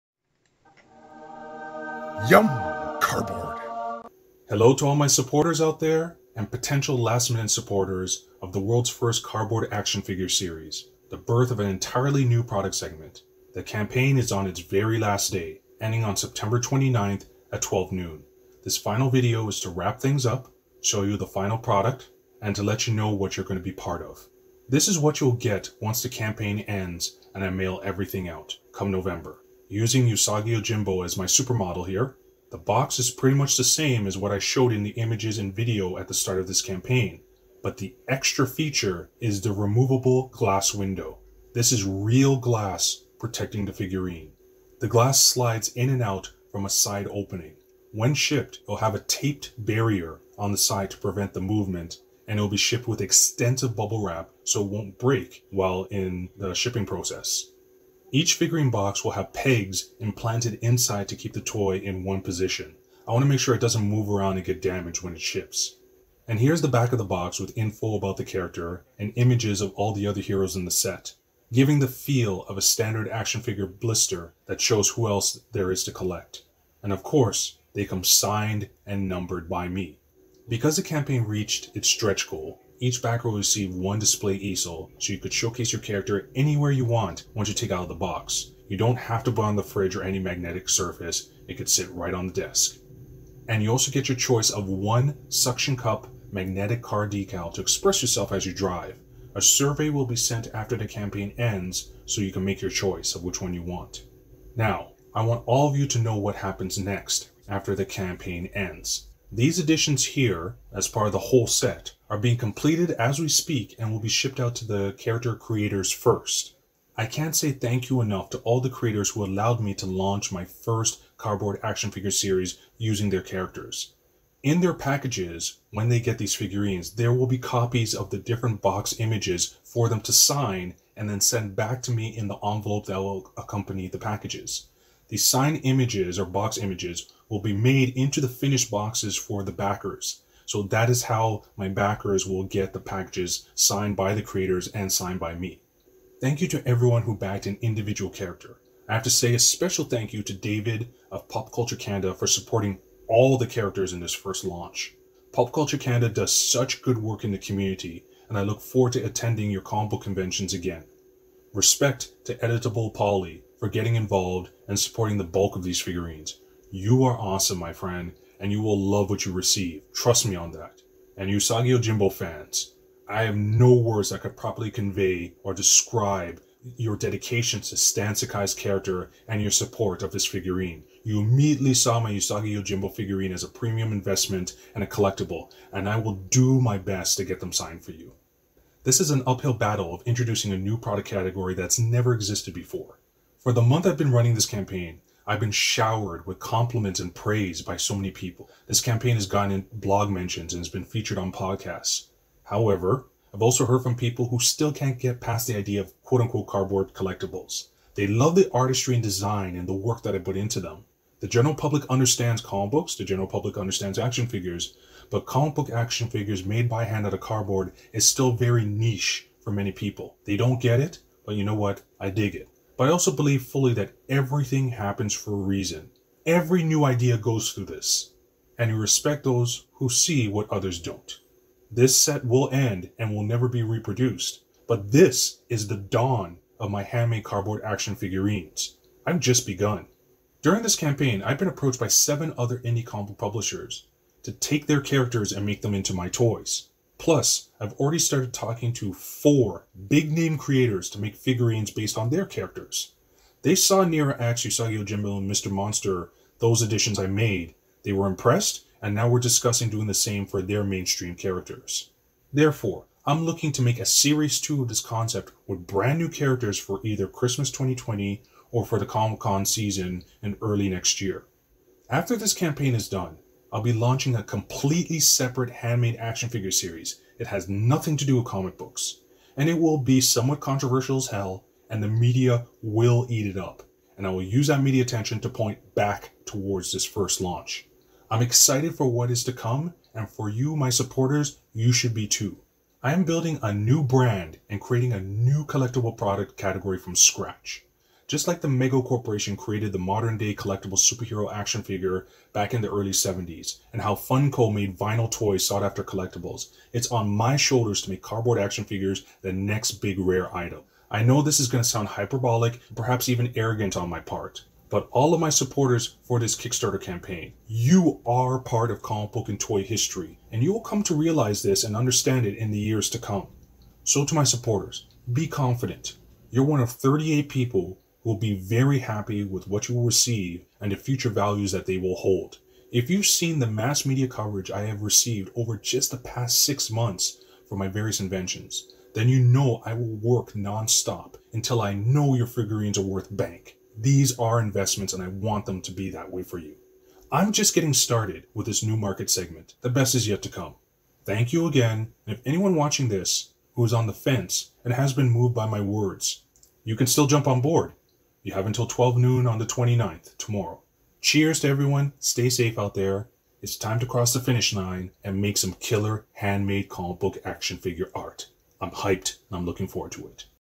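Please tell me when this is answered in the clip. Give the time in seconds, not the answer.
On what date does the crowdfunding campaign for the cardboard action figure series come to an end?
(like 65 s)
16 s.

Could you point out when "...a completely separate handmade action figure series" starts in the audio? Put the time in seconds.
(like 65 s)
274 s.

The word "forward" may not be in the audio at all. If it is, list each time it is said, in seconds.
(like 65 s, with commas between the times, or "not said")
158 s, 369 s.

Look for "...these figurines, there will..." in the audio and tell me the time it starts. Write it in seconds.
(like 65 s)
126 s.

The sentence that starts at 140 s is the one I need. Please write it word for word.
So that is how my backers will get the packages signed by the creators and signed by me.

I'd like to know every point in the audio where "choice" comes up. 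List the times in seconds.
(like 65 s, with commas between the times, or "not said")
94 s, 102 s.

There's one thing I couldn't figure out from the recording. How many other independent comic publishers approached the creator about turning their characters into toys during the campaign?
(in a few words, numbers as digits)
7.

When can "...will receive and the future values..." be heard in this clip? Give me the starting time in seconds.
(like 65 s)
329 s.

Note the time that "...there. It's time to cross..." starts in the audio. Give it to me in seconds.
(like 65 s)
362 s.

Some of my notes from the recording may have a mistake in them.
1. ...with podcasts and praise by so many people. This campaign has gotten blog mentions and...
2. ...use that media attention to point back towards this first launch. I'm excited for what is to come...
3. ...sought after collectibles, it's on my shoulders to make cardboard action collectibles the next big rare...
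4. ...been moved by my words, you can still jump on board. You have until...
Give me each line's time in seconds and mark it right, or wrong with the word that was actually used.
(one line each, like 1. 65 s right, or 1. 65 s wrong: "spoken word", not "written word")
1. 196 s wrong: "compliments", not "podcasts"
2. 284 s right
3. 305 s wrong: "figures", not "collectibles"
4. 354 s right.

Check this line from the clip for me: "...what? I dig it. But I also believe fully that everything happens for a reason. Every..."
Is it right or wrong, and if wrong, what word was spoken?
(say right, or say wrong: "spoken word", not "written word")
right.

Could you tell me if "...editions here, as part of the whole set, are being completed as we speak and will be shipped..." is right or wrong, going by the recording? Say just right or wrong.
right.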